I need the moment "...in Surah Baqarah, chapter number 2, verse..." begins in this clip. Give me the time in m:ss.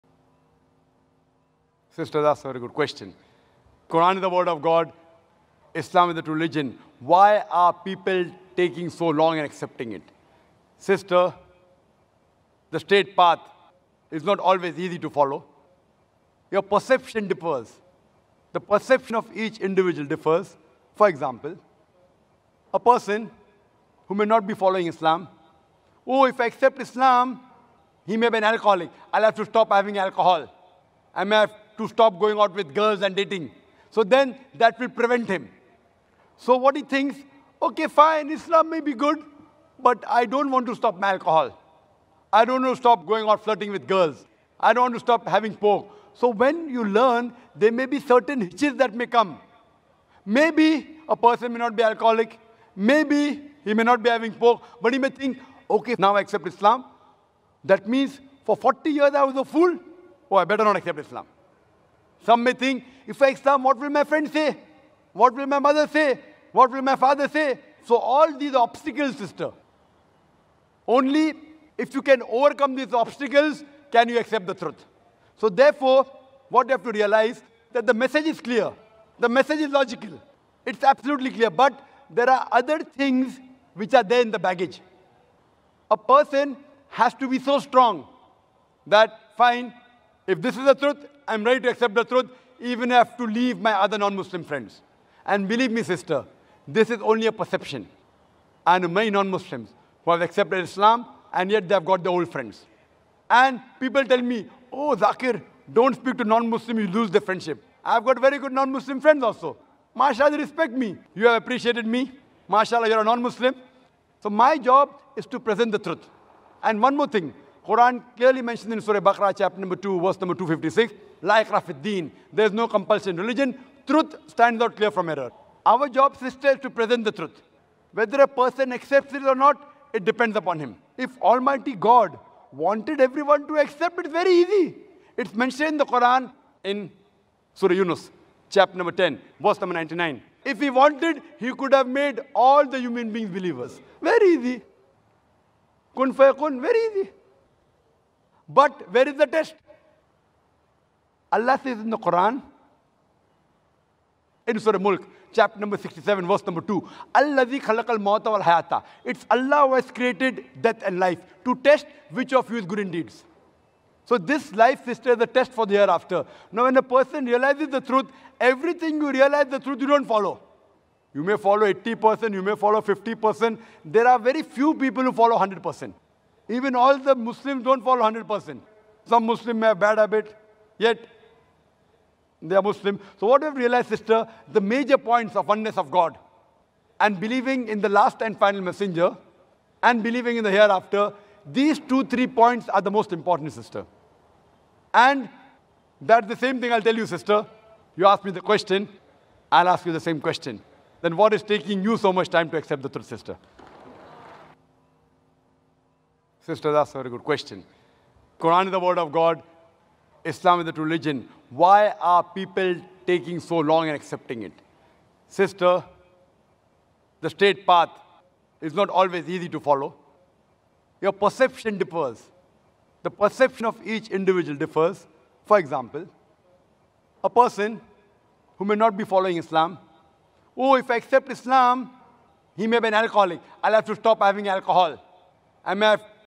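1:58.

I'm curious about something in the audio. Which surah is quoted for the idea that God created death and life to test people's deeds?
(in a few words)
Surah Mulk.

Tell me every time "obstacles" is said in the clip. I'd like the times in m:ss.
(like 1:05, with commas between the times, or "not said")
1:08, 1:12.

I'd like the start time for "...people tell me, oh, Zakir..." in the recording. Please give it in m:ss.
1:43.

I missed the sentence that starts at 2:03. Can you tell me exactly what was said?
Truth stands out clear from error.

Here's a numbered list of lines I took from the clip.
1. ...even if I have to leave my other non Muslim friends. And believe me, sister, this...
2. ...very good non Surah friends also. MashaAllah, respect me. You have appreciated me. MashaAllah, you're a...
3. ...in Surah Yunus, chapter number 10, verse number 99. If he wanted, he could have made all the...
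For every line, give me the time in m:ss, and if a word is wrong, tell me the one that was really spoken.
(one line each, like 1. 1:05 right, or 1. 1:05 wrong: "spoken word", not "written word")
1. 1:32 right
2. 1:48 wrong: "Muslim", not "Surah"
3. 2:16 right.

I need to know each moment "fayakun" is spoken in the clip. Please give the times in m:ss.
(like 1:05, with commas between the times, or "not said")
2:26.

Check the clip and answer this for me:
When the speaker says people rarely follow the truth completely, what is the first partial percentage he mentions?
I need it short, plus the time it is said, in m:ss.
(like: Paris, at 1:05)
80%, at 2:51.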